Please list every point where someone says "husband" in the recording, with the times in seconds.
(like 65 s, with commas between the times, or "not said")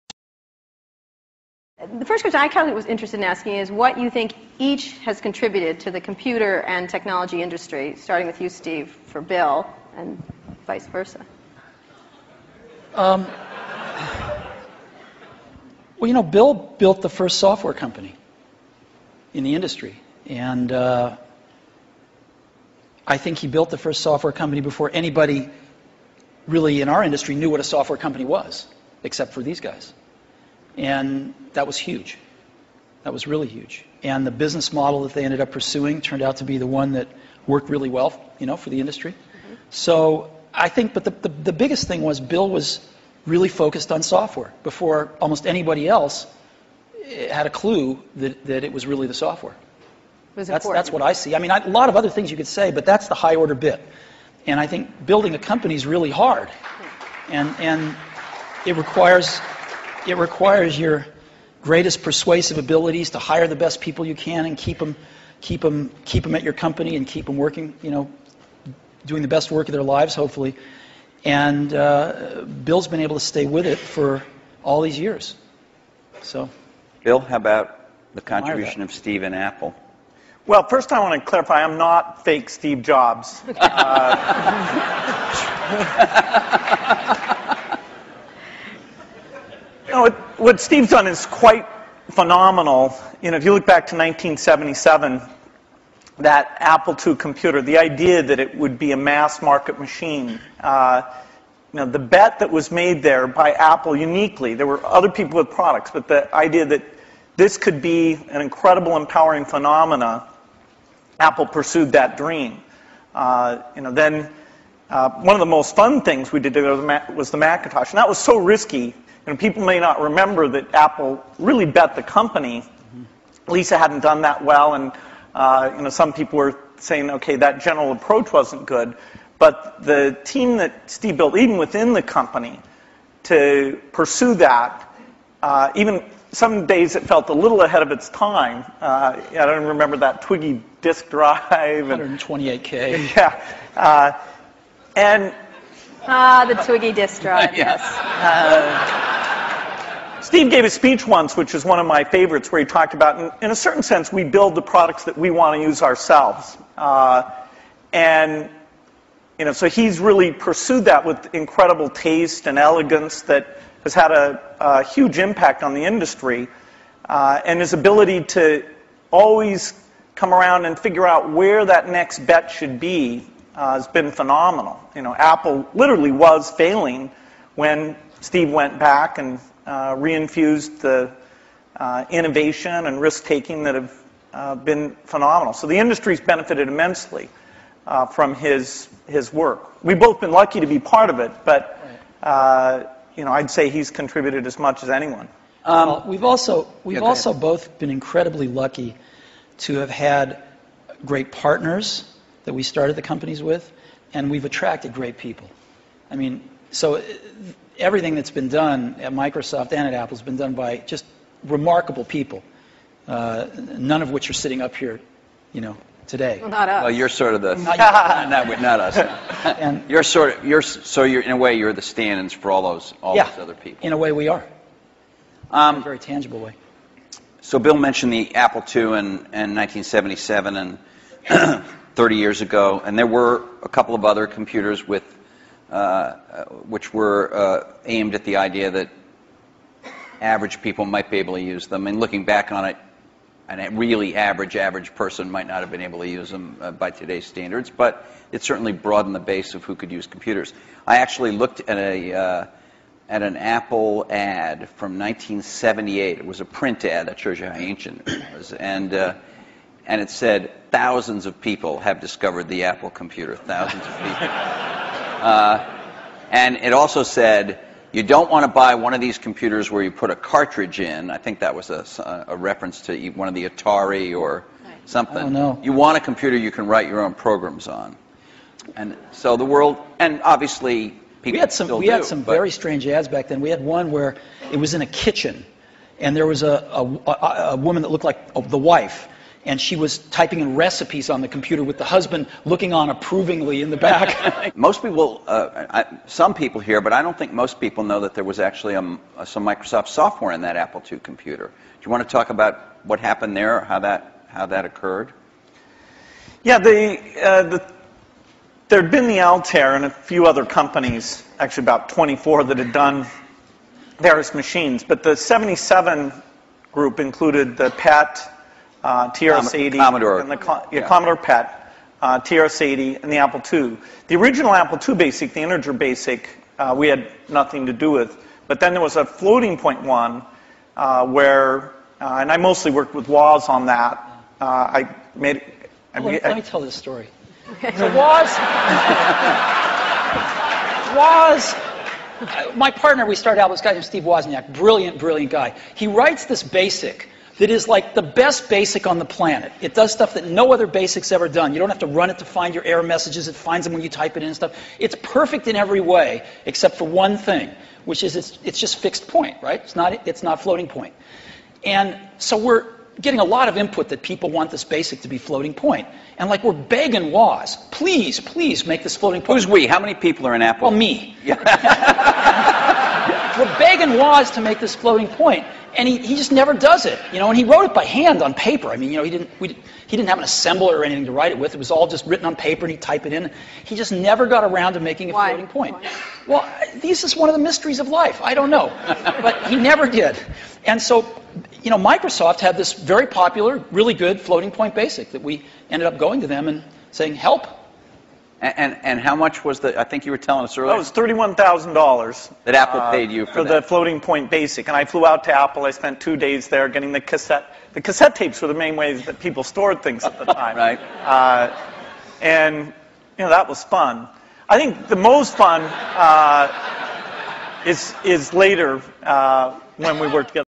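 291 s.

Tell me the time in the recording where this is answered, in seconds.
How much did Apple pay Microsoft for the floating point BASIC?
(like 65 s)
400 s.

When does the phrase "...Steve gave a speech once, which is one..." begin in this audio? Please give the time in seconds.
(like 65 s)
150 s.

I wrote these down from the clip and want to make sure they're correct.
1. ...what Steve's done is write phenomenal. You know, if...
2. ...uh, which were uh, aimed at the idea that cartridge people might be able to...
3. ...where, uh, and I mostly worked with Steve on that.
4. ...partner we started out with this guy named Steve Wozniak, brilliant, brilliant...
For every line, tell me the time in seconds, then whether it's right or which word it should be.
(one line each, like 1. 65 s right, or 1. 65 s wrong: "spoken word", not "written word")
1. 90 s wrong: "quite", not "write"
2. 235 s wrong: "average", not "cartridge"
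3. 331 s wrong: "Waz", not "Steve"
4. 342 s right.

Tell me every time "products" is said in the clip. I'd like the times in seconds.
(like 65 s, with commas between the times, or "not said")
105 s, 154 s.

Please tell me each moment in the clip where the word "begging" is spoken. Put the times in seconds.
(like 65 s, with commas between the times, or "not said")
366 s, 373 s.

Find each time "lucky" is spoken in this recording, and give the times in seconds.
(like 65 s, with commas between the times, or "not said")
190 s, 198 s.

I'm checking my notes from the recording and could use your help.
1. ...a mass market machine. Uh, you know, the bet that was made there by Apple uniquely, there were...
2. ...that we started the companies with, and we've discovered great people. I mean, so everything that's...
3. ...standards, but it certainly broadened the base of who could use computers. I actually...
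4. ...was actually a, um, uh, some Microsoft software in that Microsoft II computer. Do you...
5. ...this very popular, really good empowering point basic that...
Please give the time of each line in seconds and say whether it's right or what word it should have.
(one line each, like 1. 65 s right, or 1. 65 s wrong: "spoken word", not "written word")
1. 98 s right
2. 202 s wrong: "attracted", not "discovered"
3. 247 s right
4. 298 s wrong: "Apple", not "Microsoft"
5. 392 s wrong: "floating", not "empowering".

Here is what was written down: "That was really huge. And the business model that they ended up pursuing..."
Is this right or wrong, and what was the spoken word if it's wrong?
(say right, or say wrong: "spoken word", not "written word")
right.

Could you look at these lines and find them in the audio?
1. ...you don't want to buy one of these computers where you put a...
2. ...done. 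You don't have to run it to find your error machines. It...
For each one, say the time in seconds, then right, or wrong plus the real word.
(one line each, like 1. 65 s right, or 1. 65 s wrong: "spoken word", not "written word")
1. 267 s right
2. 351 s wrong: "messages", not "machines".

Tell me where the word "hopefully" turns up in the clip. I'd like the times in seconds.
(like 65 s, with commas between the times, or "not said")
70 s.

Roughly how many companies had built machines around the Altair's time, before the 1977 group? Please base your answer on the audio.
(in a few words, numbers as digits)
About 24.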